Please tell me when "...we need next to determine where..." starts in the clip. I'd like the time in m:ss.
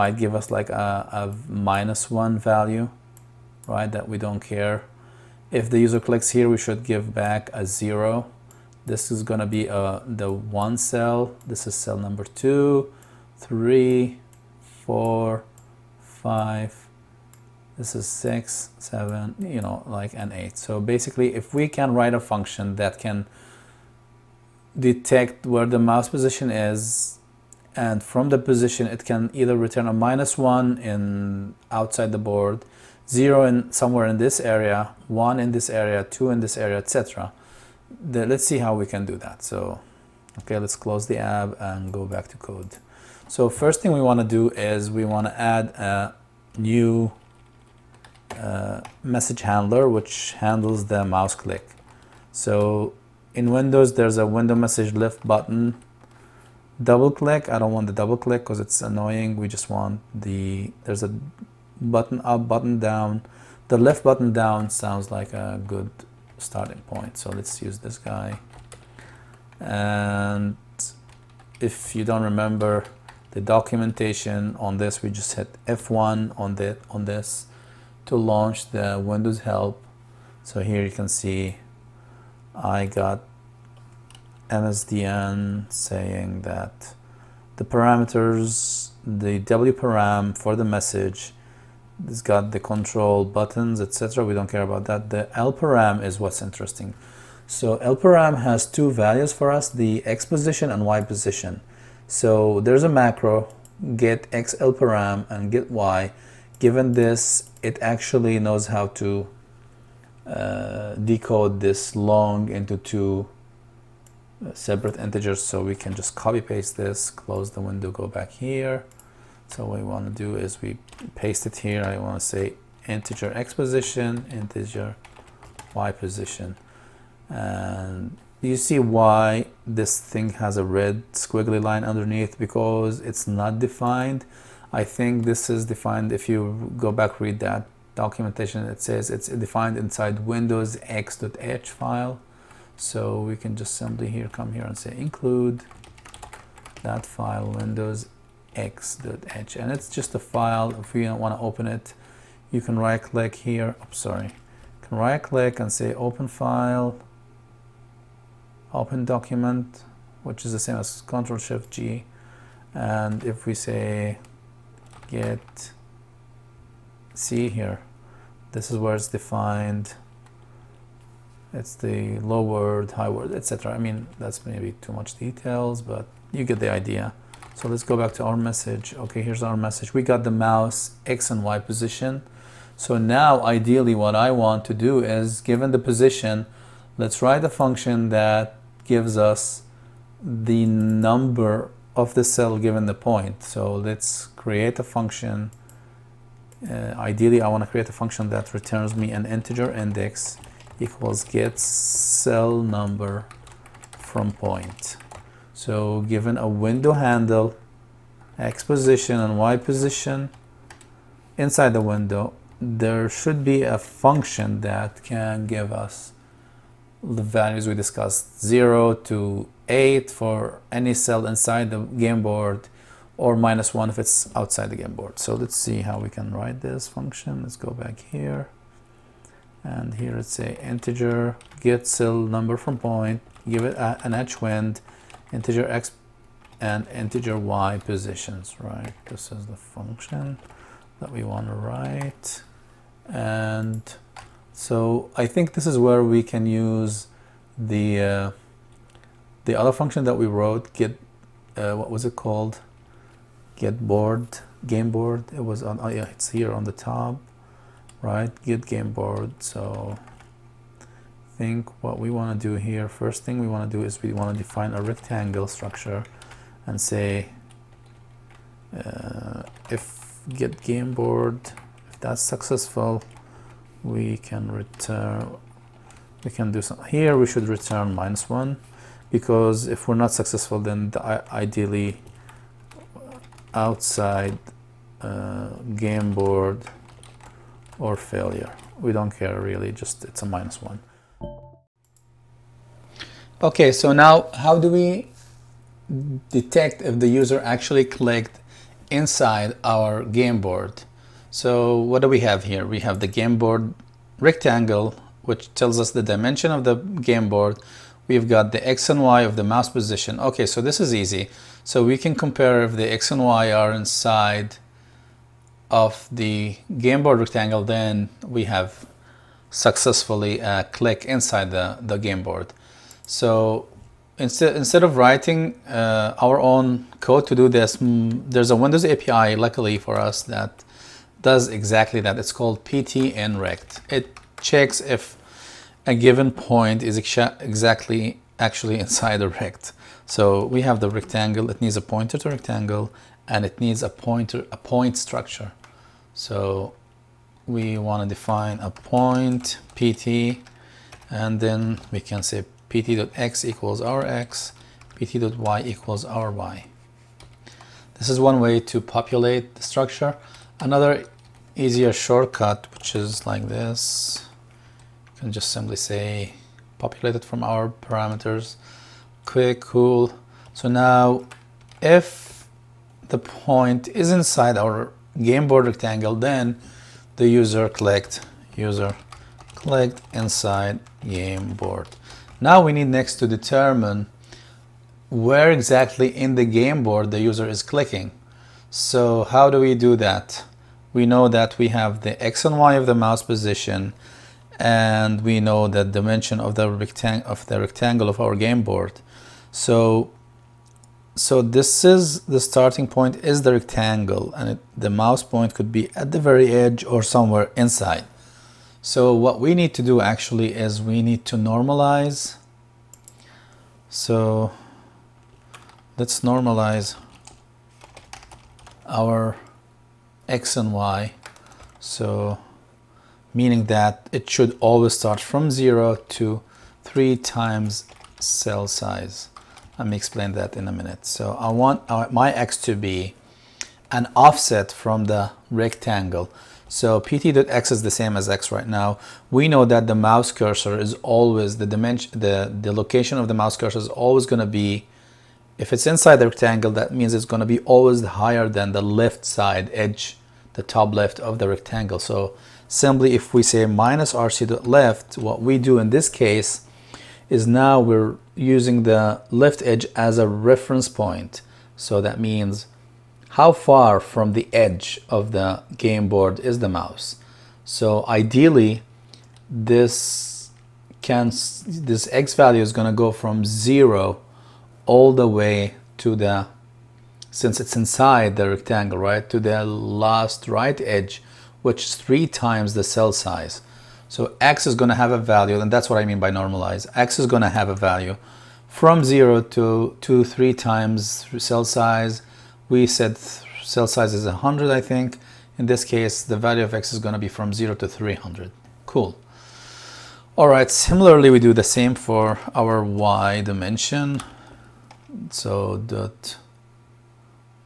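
6:22.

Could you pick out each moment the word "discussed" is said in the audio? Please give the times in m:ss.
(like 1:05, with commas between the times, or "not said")
3:37.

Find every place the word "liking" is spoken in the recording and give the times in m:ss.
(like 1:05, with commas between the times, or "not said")
not said.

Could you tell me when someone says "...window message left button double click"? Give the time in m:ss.
0:54.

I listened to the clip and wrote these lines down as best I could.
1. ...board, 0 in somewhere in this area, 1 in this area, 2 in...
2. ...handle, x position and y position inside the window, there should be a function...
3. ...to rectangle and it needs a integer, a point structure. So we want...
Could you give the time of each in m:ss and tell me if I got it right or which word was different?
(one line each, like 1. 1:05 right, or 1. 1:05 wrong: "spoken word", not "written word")
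1. 0:32 right
2. 3:26 right
3. 5:42 wrong: "pointer", not "integer".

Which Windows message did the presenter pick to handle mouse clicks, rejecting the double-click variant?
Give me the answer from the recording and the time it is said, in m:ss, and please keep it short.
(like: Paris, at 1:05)
left button down, at 1:03.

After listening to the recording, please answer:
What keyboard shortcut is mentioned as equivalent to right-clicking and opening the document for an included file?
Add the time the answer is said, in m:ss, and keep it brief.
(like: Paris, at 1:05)
Control Shift G, at 2:41.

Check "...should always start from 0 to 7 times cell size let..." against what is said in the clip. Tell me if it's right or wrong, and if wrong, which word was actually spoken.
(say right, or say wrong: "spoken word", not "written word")
wrong: "3", not "7".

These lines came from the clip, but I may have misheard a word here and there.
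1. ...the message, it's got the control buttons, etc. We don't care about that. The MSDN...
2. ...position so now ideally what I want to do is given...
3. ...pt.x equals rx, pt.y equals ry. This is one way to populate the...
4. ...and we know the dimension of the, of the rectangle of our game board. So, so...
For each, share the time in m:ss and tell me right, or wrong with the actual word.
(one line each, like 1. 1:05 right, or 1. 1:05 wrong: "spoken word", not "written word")
1. 1:30 wrong: "LParam", not "MSDN"
2. 3:01 right
3. 5:52 right
4. 6:34 right.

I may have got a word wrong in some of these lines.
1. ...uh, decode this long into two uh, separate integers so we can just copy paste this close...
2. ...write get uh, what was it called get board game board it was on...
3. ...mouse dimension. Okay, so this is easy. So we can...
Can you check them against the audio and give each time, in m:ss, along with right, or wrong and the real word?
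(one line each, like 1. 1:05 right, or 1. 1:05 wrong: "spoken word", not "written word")
1. 1:50 right
2. 4:10 wrong: "wrote", not "write"
3. 5:09 wrong: "position", not "dimension".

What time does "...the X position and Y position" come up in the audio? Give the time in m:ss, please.
1:39.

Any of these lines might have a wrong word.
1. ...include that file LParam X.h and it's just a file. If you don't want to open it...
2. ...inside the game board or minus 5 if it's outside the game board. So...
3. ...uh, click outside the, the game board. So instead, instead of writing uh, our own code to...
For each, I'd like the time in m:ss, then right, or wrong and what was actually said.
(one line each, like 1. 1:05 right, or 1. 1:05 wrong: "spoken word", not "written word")
1. 2:24 wrong: "Windows", not "LParam"
2. 3:41 wrong: "1", not "5"
3. 5:20 wrong: "inside", not "outside".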